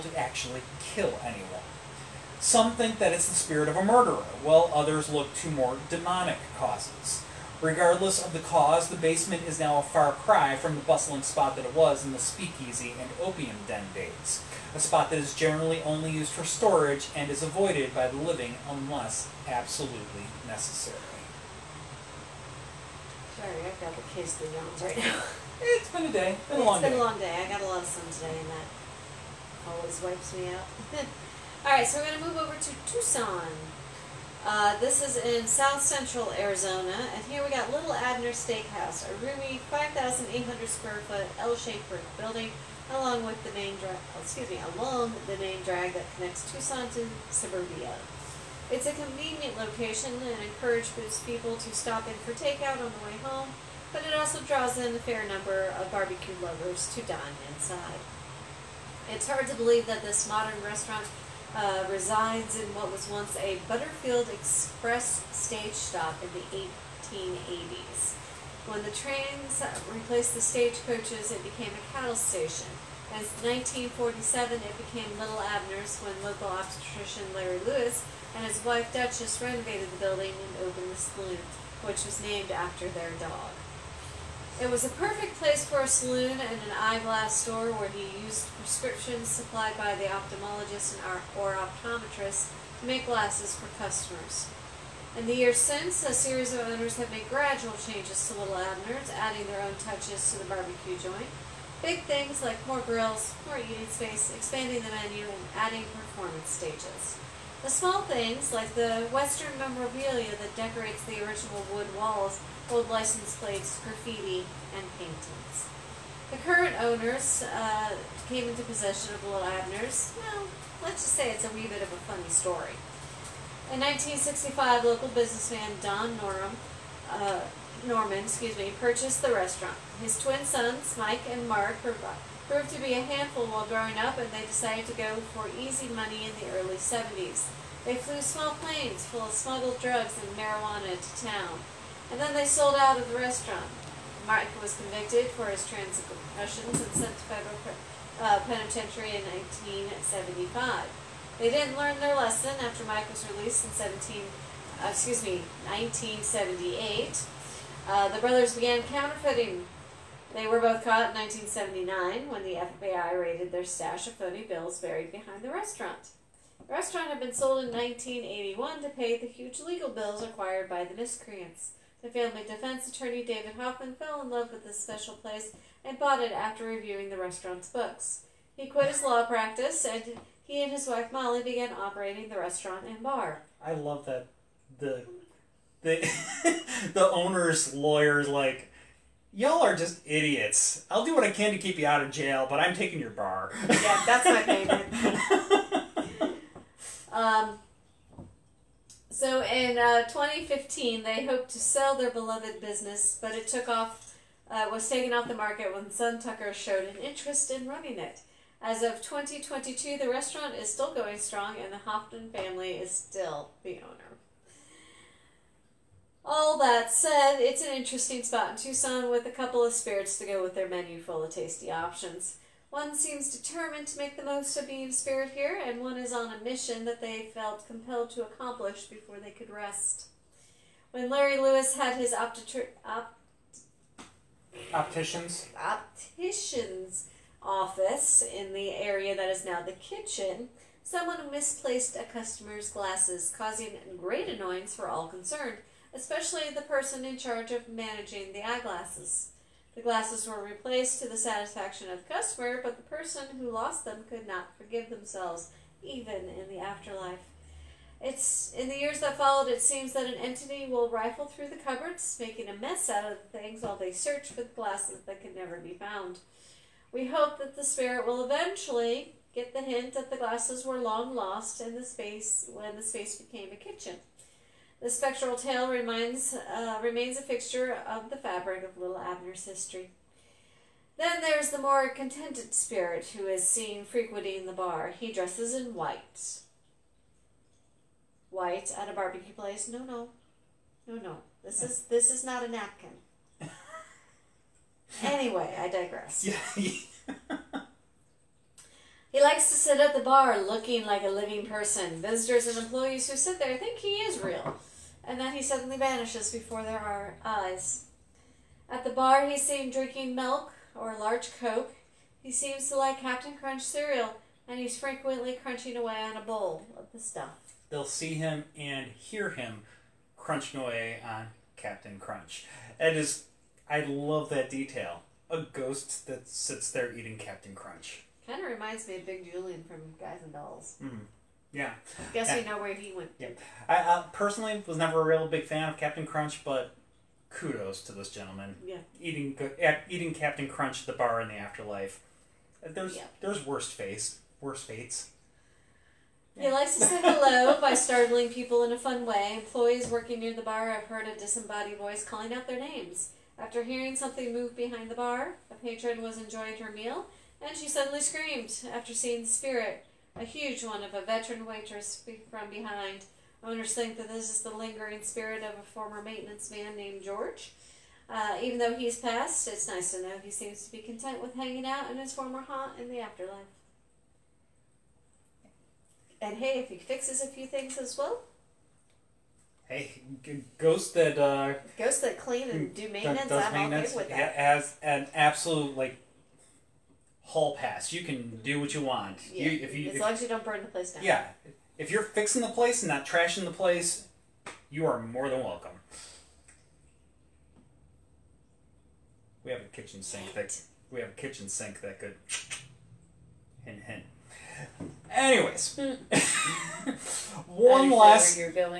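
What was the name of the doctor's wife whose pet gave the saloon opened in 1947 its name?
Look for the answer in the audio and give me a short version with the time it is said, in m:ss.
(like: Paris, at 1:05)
Duchess, at 1:18.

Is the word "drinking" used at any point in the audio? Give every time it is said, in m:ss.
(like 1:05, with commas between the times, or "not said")
5:09.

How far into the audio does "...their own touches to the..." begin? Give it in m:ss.
1:39.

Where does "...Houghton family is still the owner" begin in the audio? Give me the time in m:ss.
3:31.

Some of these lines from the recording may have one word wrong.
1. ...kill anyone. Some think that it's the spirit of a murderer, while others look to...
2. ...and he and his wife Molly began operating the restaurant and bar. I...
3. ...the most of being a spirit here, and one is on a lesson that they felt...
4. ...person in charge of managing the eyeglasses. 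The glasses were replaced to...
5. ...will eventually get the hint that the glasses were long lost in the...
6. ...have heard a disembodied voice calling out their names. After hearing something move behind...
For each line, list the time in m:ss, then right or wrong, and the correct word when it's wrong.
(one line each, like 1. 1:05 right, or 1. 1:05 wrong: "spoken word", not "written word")
1. 0:00 right
2. 2:59 right
3. 3:44 wrong: "mission", not "lesson"
4. 4:06 right
5. 4:28 right
6. 5:50 right.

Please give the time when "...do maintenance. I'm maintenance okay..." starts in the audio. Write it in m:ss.
6:22.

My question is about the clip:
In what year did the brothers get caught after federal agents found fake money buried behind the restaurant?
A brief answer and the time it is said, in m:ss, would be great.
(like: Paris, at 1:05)
1979, at 2:41.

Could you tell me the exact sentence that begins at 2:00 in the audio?
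Well, let's just say it's a wee bit of a funny story.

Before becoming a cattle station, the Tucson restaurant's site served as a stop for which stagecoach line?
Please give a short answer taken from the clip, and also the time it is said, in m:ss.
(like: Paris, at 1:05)
Butterfield Express, at 1:03.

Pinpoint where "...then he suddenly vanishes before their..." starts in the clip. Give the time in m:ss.
5:05.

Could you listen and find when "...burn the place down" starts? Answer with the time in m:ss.
6:30.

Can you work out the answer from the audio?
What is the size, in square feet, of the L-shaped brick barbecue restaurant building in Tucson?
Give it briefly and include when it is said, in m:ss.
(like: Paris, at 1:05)
5,800, at 0:39.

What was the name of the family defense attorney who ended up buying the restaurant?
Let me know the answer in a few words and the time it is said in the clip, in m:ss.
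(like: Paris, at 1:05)
David Hoffman, at 2:53.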